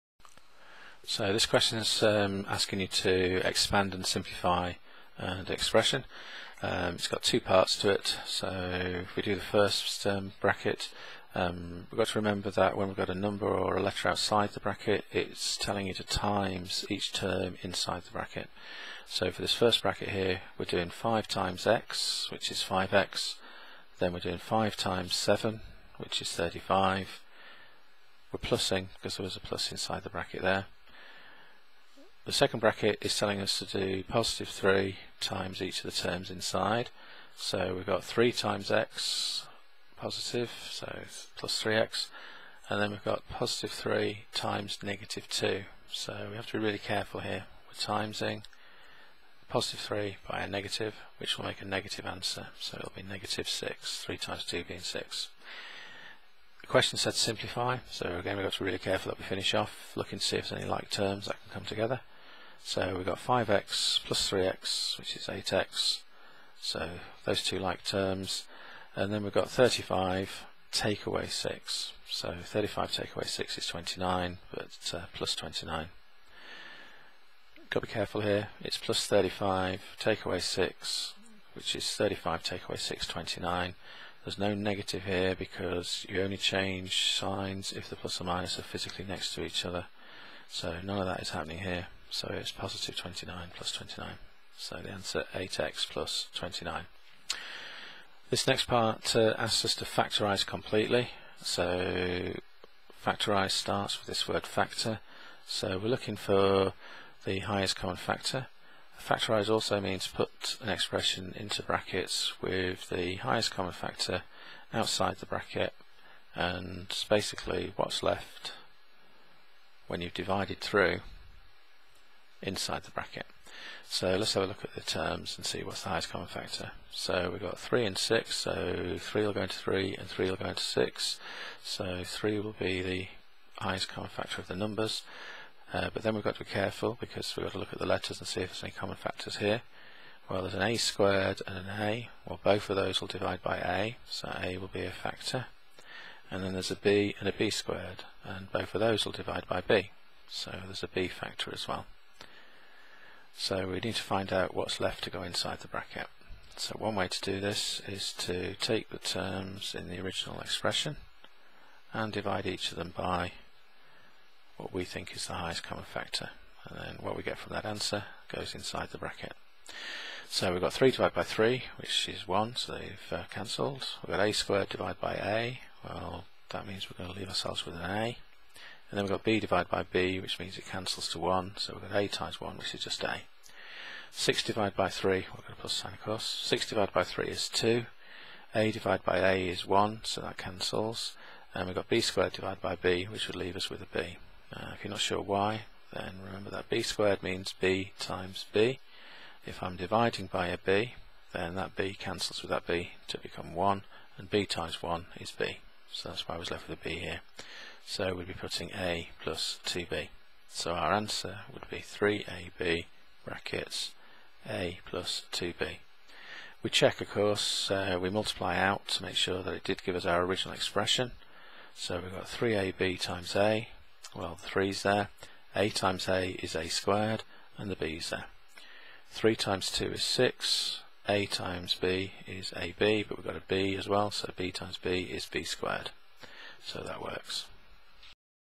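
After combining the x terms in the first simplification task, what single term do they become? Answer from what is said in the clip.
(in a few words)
8x.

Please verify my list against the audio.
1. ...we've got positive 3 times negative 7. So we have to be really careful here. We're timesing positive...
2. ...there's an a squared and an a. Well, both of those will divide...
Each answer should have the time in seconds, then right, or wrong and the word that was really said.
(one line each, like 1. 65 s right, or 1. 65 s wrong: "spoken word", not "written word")
1. 42 s wrong: "2", not "7"
2. 140 s right.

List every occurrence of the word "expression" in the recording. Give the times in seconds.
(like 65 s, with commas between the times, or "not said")
5 s, 110 s, 160 s, 220 s.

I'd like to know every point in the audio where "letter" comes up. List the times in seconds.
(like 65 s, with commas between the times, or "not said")
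13 s, 137 s.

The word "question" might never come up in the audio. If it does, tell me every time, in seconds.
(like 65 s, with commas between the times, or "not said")
1 s, 56 s.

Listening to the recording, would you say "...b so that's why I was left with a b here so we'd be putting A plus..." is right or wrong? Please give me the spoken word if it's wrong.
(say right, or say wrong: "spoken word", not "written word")
right.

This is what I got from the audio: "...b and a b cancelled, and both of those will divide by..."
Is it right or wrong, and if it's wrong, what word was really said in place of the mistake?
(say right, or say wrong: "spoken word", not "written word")
wrong: "squared", not "cancelled".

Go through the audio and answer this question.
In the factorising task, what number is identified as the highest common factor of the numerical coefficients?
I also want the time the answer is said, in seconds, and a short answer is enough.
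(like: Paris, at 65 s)
3, at 132 s.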